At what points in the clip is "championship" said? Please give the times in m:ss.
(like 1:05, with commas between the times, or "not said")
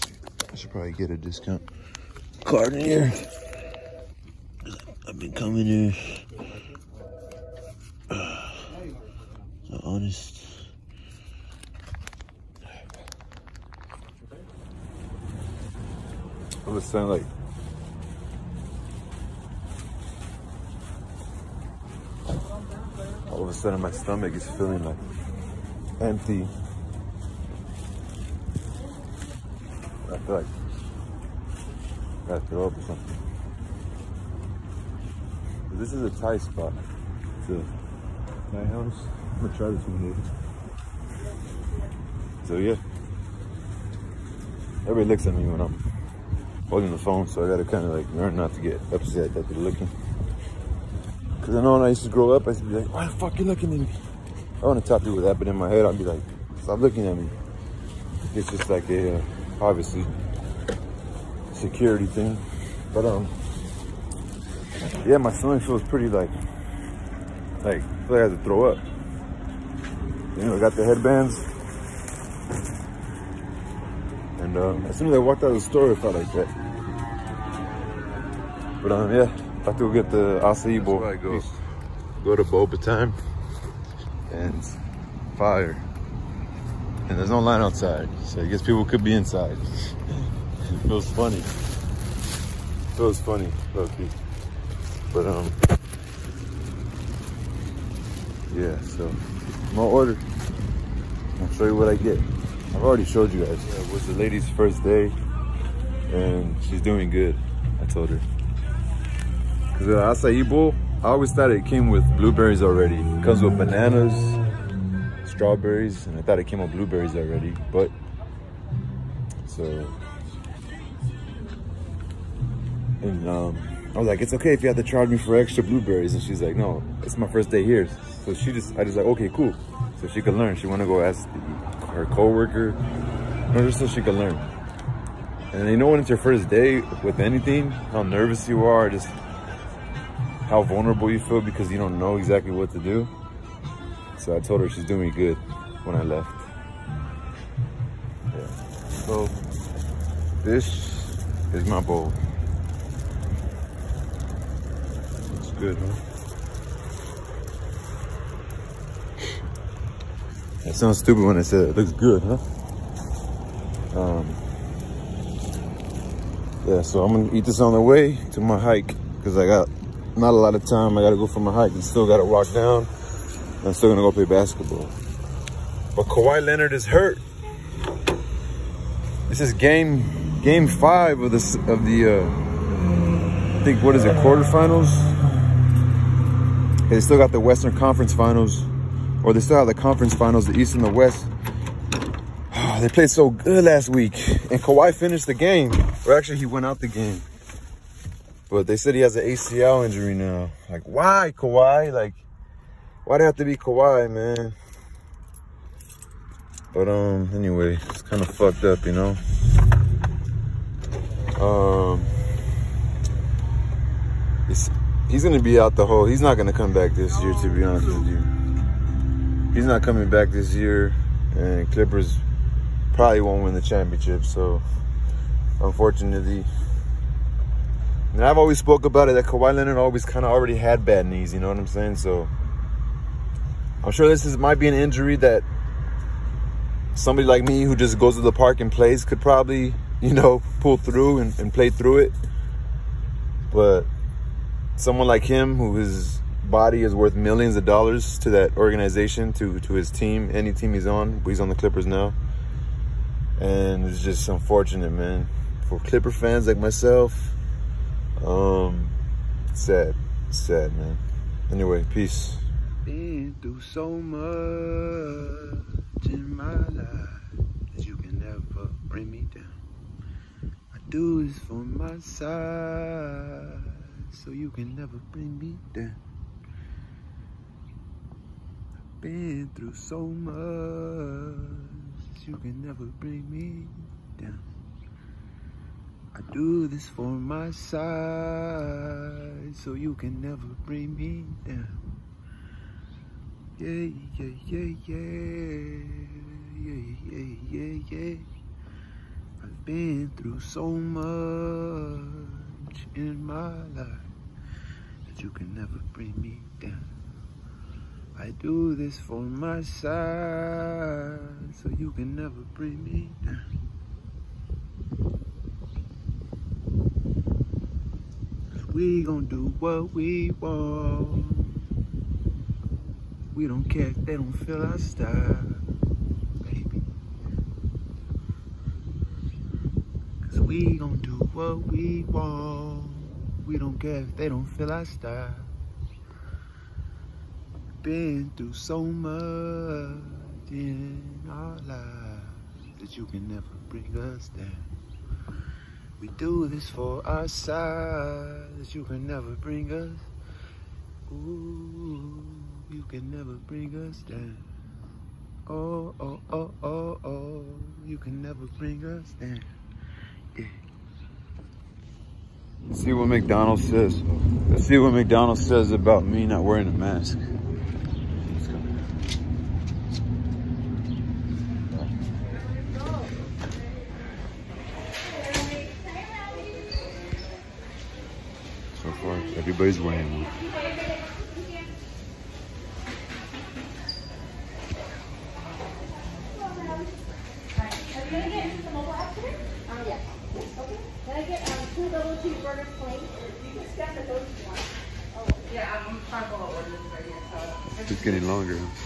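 3:43.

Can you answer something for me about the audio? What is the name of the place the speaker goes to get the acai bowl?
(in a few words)
Boba Time.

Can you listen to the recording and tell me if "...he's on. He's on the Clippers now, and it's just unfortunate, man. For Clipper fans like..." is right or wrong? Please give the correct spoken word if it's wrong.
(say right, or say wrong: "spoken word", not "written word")
right.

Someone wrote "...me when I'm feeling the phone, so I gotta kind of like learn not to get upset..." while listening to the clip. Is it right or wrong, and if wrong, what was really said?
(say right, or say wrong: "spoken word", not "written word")
wrong: "holding", not "feeling".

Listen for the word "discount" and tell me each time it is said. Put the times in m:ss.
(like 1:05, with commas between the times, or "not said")
0:01.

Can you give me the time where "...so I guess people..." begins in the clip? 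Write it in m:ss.
1:28.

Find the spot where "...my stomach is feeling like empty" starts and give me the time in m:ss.
0:23.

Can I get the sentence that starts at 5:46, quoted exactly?
We do this for our side that you can never bring us.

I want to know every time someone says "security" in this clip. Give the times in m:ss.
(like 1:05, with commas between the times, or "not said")
1:01.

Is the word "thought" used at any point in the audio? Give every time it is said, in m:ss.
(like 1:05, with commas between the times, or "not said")
1:51, 1:56.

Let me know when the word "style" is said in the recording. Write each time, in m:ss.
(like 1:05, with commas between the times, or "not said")
5:24, 5:34.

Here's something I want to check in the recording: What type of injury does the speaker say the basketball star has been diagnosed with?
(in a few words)
ACL injury.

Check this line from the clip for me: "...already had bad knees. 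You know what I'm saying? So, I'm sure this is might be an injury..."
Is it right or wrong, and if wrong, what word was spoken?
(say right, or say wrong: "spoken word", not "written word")
right.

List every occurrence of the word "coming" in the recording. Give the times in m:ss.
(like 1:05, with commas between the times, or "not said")
0:05, 3:39.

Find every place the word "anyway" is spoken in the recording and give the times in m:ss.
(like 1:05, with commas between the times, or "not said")
3:27, 4:21.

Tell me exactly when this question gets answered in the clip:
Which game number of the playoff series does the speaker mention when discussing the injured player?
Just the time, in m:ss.
3:00.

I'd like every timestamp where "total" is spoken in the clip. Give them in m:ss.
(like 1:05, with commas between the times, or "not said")
not said.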